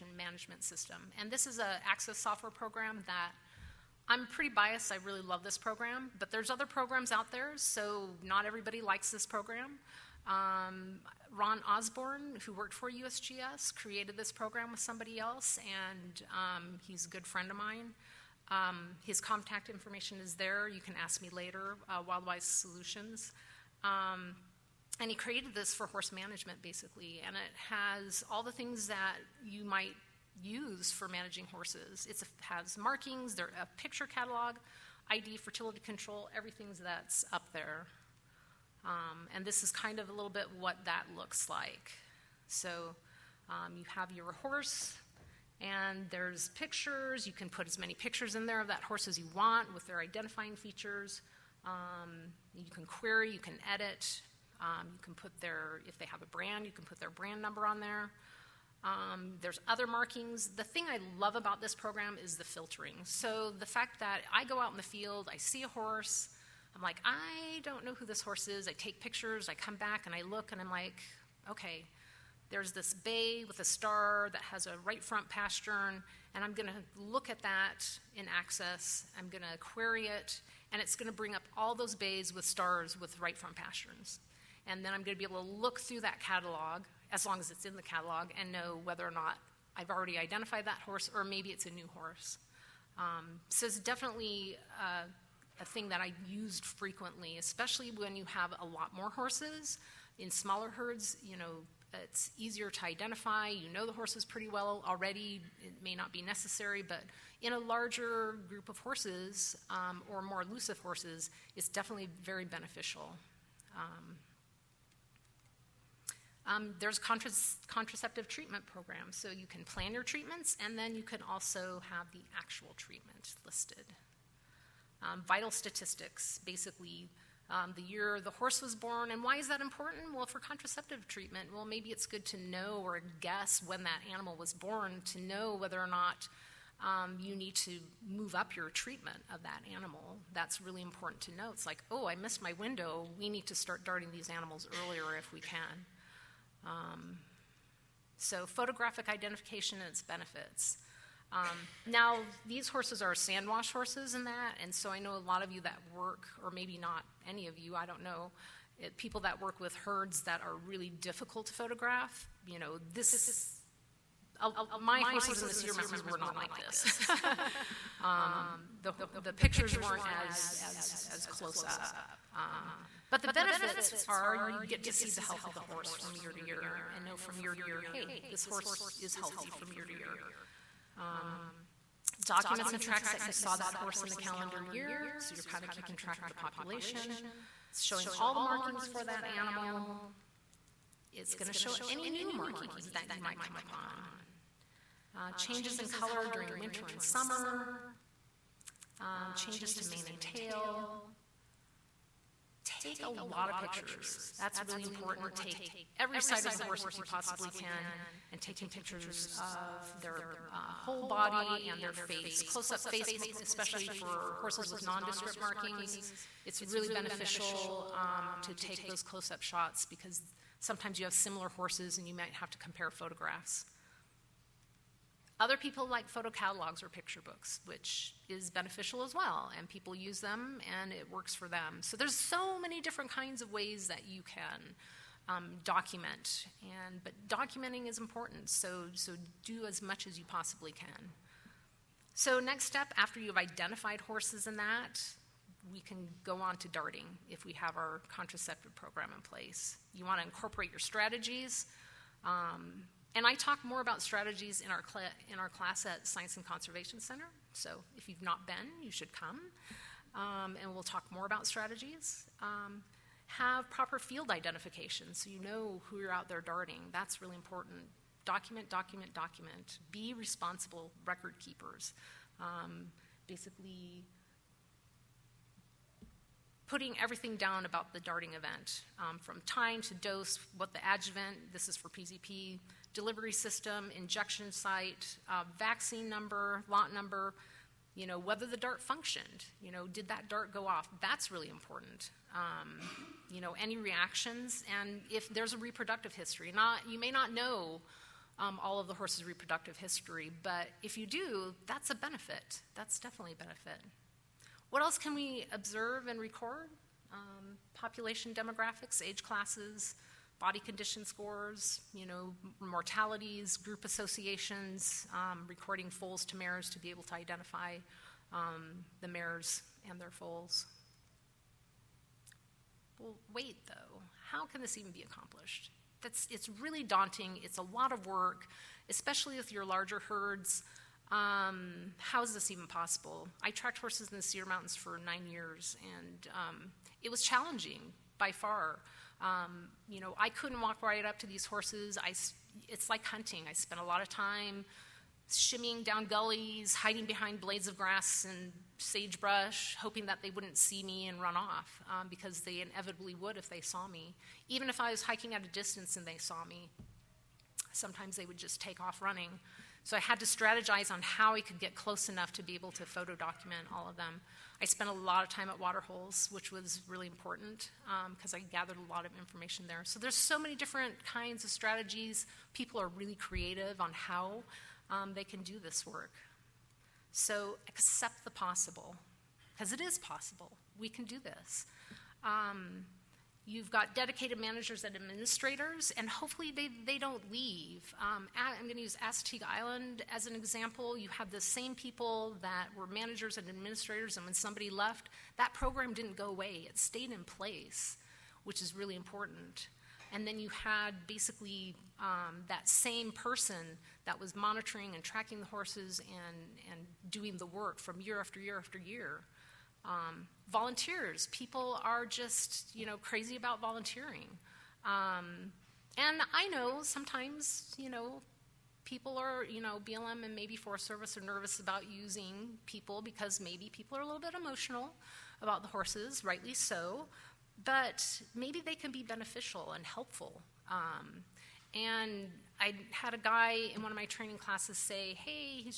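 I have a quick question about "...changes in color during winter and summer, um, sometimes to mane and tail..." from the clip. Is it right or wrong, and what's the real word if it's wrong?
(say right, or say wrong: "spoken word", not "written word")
wrong: "changes", not "sometimes".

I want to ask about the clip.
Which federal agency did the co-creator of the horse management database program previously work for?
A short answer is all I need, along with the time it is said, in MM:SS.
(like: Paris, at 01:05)
USGS, at 00:12.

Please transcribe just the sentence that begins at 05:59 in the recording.
So I had to strategize on how I could get close enough to be able to photo document all of them.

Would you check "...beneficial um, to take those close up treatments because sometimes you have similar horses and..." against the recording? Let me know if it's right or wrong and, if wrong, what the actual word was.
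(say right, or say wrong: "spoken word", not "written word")
wrong: "shots", not "treatments".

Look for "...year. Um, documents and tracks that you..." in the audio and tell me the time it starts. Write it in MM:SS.
02:59.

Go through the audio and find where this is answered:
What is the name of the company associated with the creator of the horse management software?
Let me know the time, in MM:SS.
00:22.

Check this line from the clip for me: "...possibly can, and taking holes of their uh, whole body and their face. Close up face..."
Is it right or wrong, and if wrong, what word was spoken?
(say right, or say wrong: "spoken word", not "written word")
wrong: "pictures", not "holes".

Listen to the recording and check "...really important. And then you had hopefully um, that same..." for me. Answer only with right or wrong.
wrong.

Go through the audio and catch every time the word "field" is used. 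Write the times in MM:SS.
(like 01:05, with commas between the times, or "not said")
01:04, 04:23.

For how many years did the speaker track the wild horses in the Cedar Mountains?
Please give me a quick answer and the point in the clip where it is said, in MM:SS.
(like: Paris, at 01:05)
9, at 05:35.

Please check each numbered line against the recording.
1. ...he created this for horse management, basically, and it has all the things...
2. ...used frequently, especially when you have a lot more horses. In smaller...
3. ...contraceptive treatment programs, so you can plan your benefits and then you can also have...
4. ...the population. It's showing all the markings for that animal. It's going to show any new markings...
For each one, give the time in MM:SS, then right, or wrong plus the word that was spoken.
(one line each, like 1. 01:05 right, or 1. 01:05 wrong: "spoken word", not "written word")
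1. 00:25 right
2. 01:36 right
3. 01:56 wrong: "treatments", not "benefits"
4. 03:06 right.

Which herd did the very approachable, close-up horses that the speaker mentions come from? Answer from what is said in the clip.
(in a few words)
Sand Wash.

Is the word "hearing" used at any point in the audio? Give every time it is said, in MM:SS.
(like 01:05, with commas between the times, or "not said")
not said.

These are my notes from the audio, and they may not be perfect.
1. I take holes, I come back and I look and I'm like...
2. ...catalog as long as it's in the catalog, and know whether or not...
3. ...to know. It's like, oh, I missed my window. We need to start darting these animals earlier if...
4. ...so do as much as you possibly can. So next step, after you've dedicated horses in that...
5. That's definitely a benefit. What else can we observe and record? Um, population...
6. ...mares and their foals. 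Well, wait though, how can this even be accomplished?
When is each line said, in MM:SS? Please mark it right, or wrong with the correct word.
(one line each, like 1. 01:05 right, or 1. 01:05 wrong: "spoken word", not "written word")
1. 01:08 wrong: "pictures", not "holes"
2. 01:26 right
3. 02:21 right
4. 03:58 wrong: "identified", not "dedicated"
5. 05:02 right
6. 05:19 right.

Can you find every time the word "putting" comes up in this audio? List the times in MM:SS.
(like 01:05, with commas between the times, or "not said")
04:36.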